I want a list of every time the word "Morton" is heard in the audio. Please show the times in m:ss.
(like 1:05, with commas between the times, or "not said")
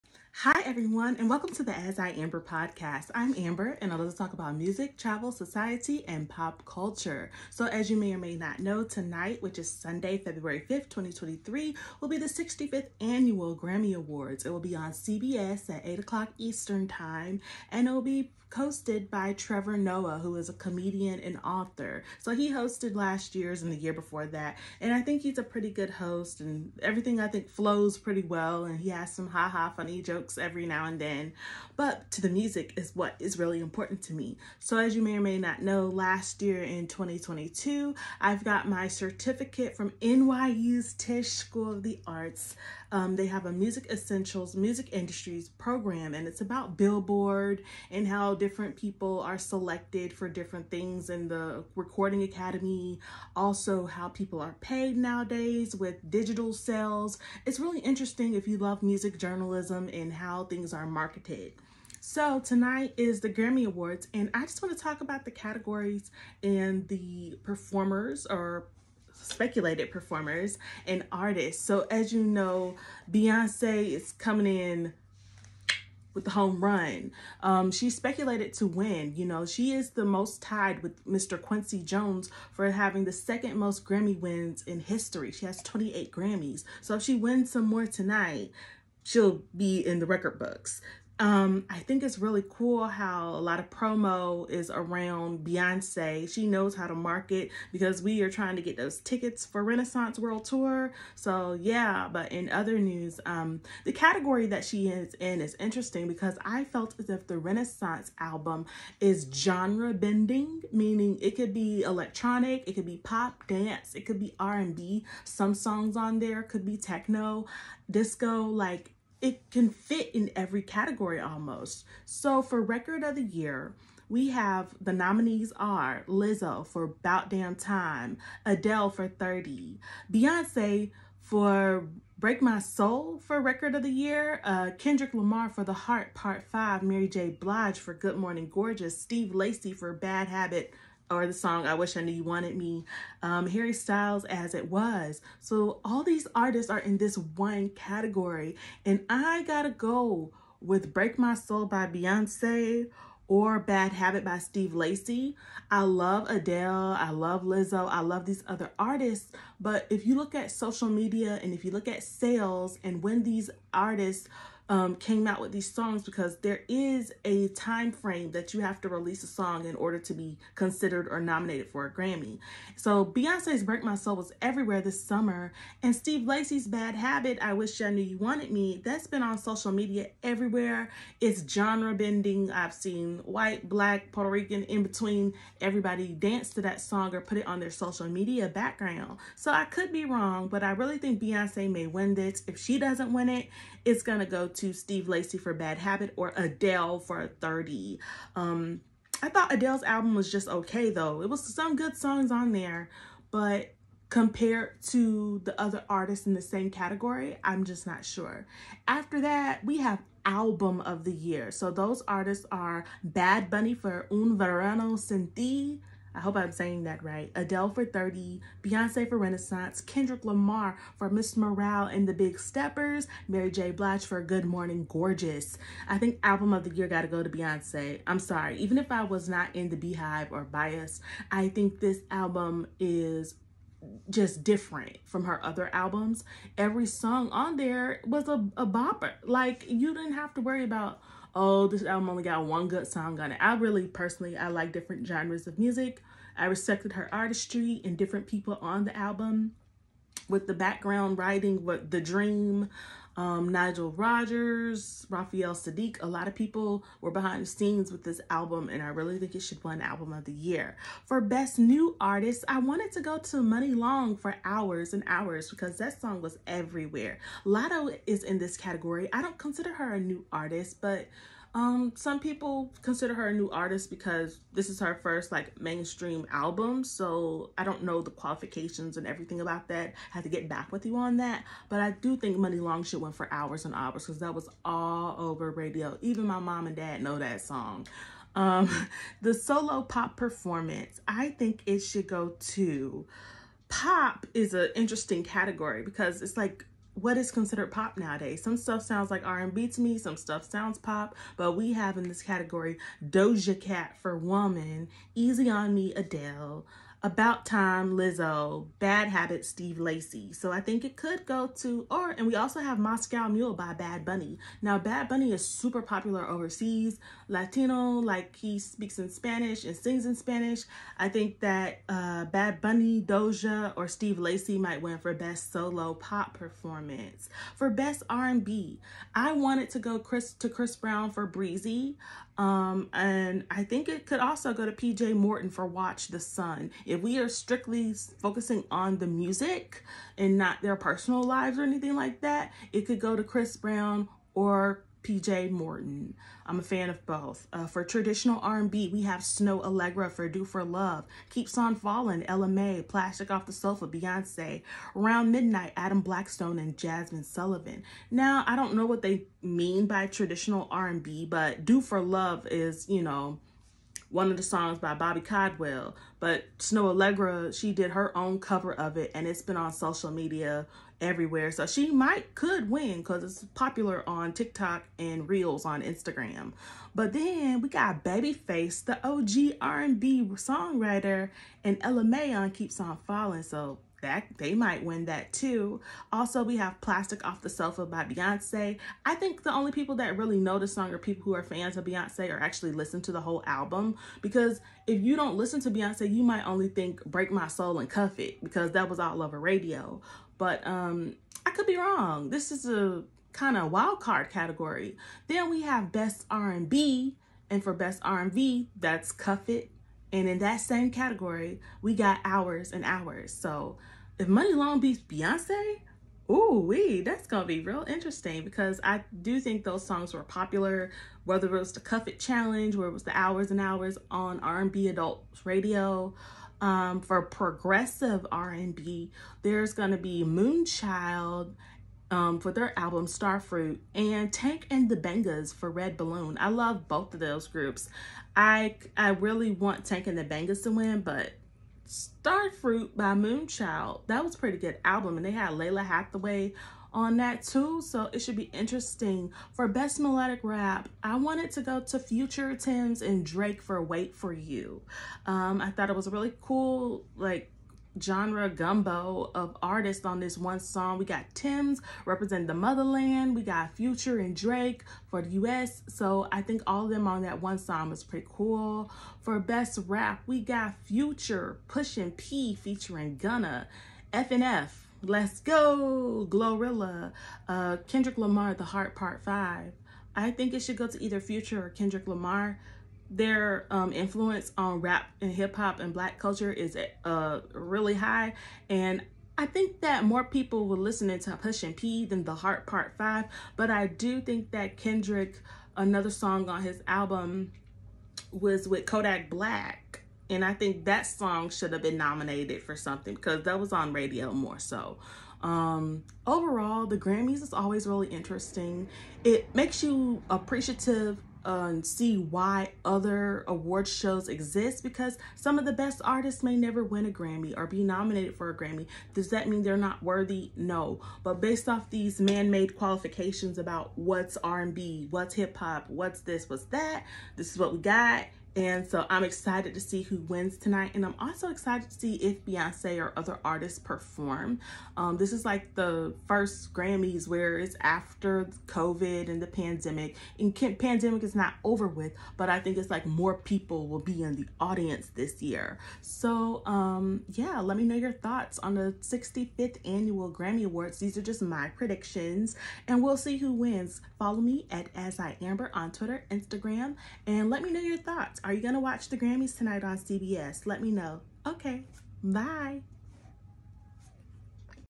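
5:35, 5:45.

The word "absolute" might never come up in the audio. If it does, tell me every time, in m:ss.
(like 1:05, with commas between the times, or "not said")
not said.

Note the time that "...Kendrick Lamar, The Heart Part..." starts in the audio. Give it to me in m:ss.
7:57.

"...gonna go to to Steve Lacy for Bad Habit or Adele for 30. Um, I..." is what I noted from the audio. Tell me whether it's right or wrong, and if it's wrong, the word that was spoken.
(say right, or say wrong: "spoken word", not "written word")
right.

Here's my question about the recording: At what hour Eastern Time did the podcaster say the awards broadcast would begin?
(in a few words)
8 o'clock.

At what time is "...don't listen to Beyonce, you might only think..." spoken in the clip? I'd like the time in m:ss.
6:35.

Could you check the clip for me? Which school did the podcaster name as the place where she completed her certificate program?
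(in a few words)
NYU's Tisch School of the Arts.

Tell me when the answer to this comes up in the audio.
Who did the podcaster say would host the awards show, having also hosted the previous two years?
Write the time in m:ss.
0:19.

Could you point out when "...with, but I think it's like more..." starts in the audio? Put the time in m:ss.
9:01.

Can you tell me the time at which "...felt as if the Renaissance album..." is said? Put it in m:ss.
1:46.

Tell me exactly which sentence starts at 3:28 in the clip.
After that, we have album of the year.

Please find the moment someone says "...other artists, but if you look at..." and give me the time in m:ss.
2:38.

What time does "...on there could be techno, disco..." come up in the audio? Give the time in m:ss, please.
1:55.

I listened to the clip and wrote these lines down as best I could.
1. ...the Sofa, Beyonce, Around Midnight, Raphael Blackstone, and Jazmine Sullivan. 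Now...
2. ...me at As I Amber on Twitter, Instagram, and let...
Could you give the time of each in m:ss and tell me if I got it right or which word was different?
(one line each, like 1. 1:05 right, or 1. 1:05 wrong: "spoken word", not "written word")
1. 5:53 wrong: "Adam", not "Raphael"
2. 9:14 right.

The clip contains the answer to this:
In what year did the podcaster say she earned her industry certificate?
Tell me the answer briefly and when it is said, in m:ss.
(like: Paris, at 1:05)
2022, at 0:36.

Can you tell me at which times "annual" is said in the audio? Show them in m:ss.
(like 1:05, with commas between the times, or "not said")
0:12, 9:09.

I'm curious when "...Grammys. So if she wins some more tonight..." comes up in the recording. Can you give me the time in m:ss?
1:26.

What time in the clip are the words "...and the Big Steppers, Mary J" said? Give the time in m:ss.
3:41.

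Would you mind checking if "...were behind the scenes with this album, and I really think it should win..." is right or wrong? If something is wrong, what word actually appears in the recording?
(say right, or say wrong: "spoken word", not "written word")
right.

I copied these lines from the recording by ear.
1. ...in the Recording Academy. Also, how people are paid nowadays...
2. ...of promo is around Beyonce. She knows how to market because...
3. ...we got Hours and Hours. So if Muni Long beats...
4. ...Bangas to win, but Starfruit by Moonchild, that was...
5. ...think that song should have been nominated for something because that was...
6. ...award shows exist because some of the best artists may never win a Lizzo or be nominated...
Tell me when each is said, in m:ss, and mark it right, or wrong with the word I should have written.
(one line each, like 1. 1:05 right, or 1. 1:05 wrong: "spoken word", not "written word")
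1. 0:51 right
2. 1:33 right
3. 6:51 right
4. 7:20 right
5. 8:20 right
6. 8:33 wrong: "Grammy", not "Lizzo".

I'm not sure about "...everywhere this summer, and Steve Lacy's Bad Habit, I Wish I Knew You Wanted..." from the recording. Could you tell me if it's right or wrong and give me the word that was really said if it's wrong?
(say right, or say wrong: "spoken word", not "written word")
right.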